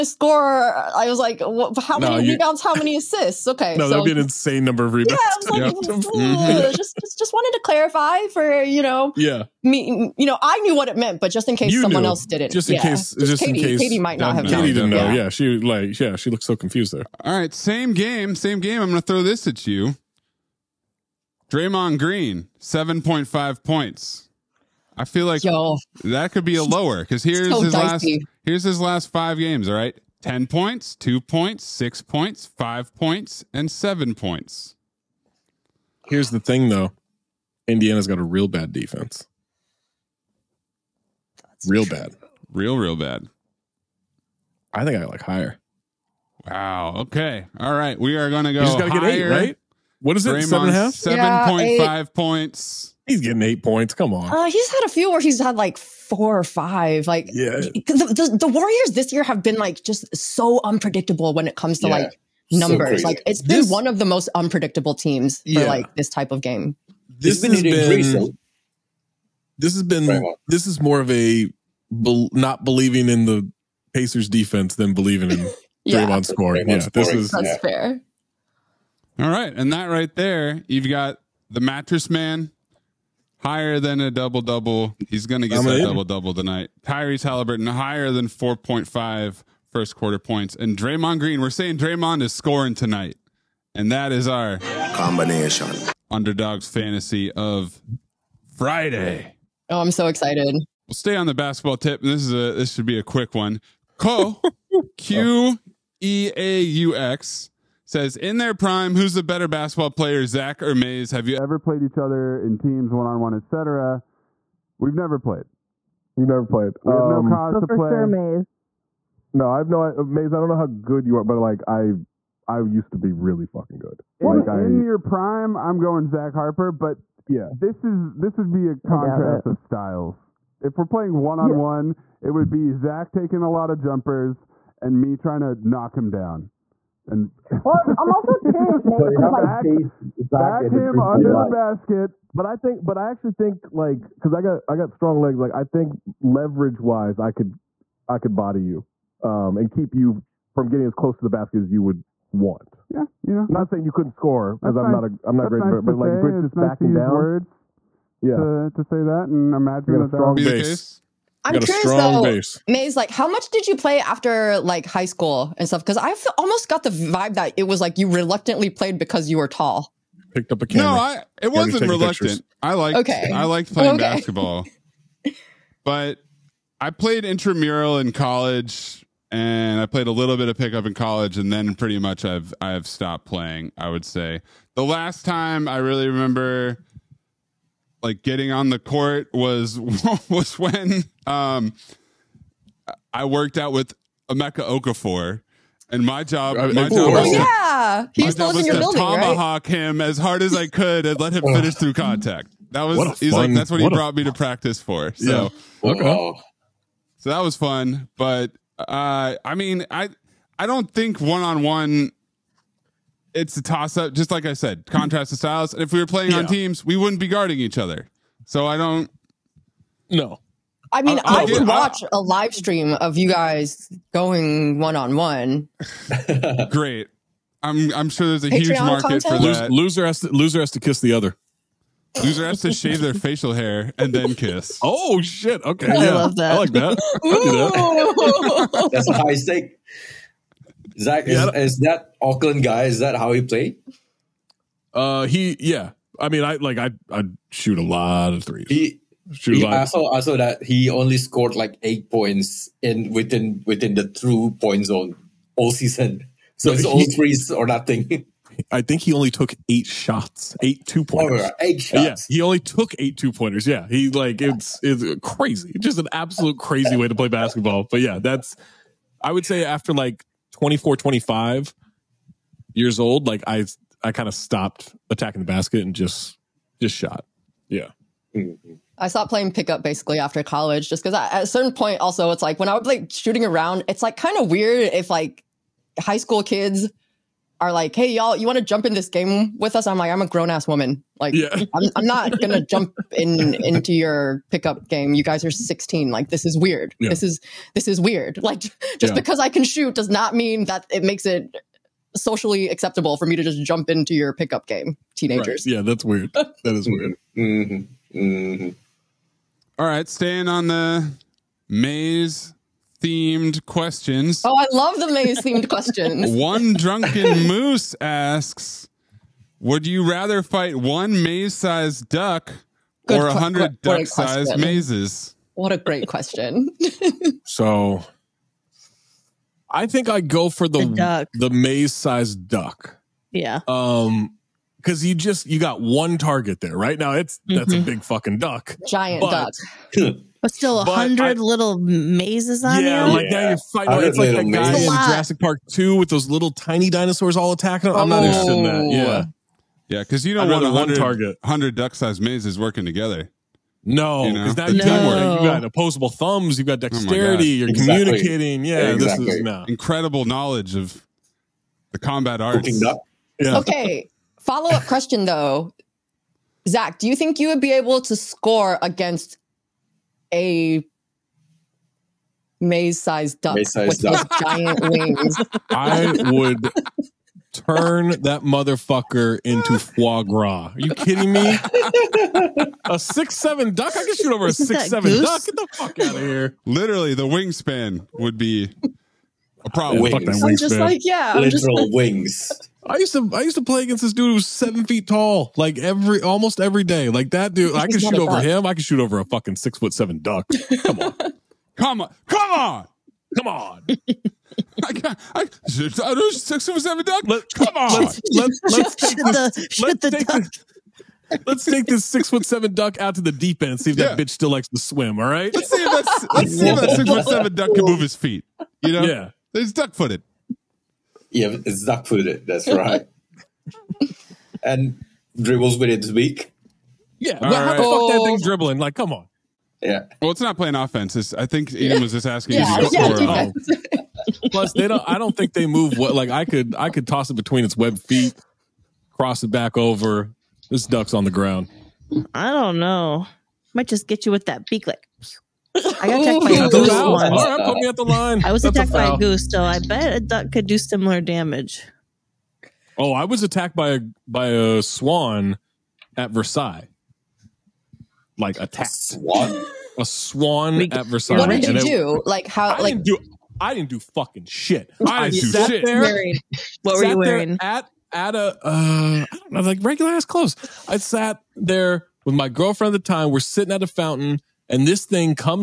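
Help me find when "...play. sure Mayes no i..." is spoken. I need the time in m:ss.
1:57.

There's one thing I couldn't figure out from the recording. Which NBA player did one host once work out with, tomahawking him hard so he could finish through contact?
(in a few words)
Emeka Okafor.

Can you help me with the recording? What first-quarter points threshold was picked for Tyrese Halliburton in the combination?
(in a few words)
4.5.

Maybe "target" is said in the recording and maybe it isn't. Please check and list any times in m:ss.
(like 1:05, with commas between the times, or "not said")
5:36, 5:50.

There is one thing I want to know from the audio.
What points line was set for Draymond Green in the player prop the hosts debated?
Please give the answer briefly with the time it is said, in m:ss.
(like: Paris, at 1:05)
7.5, at 0:22.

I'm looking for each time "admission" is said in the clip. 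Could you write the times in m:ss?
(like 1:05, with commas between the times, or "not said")
not said.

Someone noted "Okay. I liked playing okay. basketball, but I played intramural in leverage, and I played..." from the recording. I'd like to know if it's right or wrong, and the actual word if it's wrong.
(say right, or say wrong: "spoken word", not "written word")
wrong: "college", not "leverage".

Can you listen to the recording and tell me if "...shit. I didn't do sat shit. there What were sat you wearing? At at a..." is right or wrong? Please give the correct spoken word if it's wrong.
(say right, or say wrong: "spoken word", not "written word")
right.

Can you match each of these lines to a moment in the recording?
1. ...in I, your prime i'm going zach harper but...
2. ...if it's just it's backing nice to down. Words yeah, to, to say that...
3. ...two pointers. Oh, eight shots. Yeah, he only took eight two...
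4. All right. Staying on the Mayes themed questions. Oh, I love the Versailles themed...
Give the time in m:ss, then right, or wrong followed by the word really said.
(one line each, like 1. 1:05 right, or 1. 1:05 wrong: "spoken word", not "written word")
1. 2:04 right
2. 2:36 right
3. 4:20 right
4. 5:09 wrong: "Mayes", not "Versailles".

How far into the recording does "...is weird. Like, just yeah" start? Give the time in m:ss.
4:57.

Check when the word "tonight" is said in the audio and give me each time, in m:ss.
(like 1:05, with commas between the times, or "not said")
1:26, 1:32.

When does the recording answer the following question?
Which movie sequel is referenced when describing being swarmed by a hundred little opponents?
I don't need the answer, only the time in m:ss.
5:44.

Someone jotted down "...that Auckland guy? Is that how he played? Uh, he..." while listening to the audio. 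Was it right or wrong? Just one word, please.
right.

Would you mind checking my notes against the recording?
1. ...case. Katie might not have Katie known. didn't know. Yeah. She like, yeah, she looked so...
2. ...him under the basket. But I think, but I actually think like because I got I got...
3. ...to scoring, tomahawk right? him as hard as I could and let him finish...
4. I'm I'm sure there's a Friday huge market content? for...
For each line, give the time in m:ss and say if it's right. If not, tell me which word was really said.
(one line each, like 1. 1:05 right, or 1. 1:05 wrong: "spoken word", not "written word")
1. 0:13 right
2. 2:20 right
3. 3:18 wrong: "building", not "scoring"
4. 3:47 wrong: "Patreon", not "Friday".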